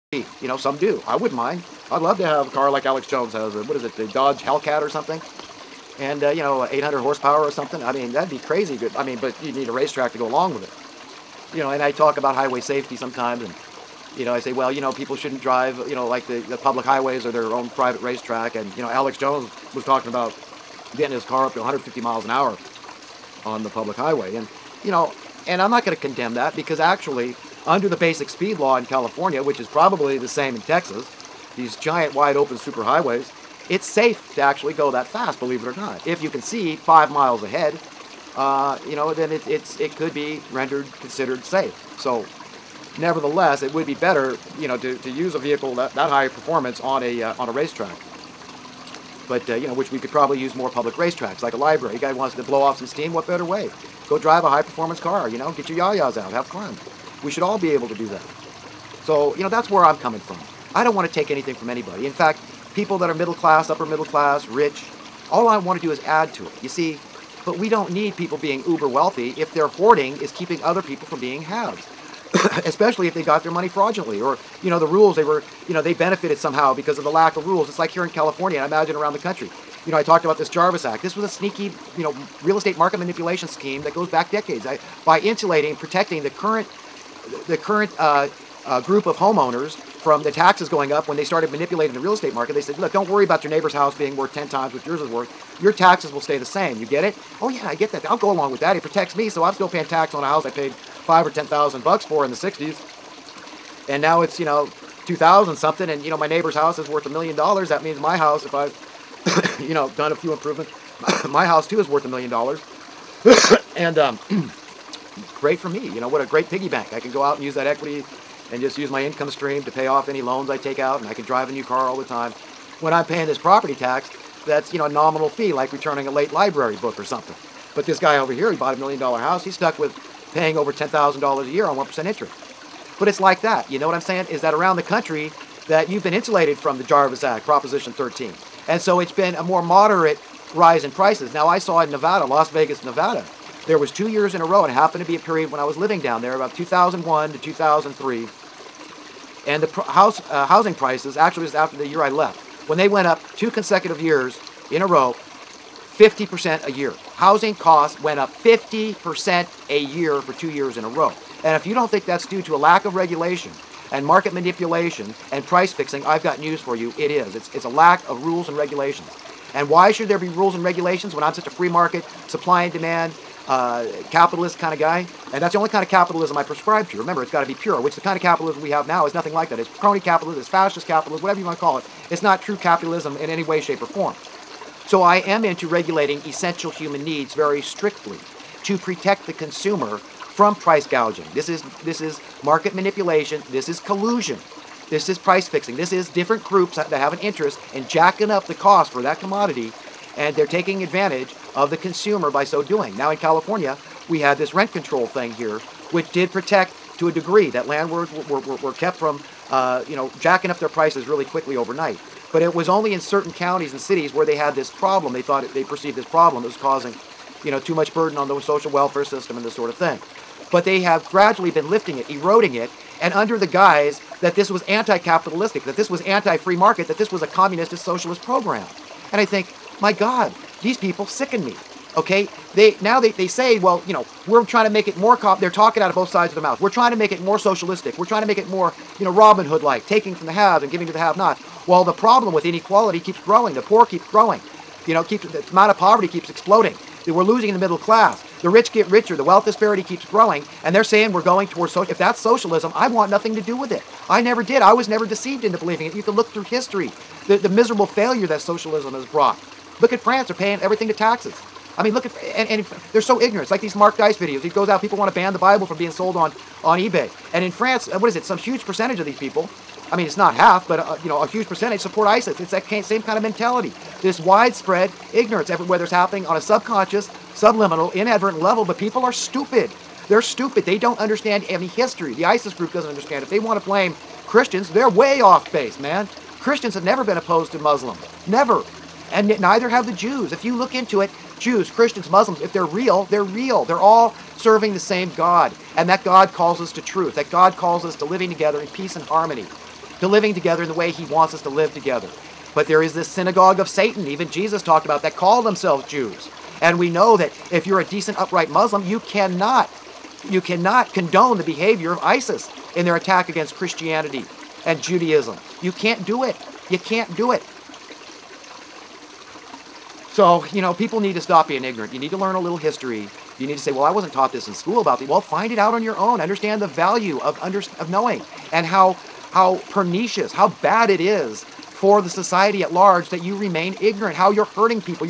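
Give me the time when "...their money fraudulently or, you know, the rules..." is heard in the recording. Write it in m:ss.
1:13.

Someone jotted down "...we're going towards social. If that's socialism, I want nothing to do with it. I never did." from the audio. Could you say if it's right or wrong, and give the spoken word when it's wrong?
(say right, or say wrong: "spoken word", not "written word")
right.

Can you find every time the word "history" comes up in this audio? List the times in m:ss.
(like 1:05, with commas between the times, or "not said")
4:16, 4:41, 5:22.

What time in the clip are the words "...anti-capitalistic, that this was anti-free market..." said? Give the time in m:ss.
3:44.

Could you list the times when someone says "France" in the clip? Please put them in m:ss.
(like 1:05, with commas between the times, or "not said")
4:19, 4:27.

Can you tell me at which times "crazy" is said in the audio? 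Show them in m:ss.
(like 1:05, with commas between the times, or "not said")
0:08.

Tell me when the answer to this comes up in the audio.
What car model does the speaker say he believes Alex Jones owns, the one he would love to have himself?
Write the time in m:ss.
0:04.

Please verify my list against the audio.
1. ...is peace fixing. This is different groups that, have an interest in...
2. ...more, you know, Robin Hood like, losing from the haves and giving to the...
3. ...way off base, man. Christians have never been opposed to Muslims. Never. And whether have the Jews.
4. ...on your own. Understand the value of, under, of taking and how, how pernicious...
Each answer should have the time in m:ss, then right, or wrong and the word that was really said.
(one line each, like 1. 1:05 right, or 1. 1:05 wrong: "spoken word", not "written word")
1. 3:15 wrong: "price", not "peace"
2. 3:58 wrong: "taking", not "losing"
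3. 4:44 wrong: "neither", not "whether"
4. 5:25 wrong: "knowing", not "taking".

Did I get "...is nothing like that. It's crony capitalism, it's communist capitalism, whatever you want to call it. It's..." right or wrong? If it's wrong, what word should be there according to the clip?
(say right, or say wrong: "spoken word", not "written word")
wrong: "fascist", not "communist".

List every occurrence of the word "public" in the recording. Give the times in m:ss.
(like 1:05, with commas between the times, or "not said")
0:16, 0:23, 0:50.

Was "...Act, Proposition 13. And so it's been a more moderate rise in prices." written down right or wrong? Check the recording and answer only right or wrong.
right.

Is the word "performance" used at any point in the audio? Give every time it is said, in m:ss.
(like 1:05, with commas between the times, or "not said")
0:46, 0:54.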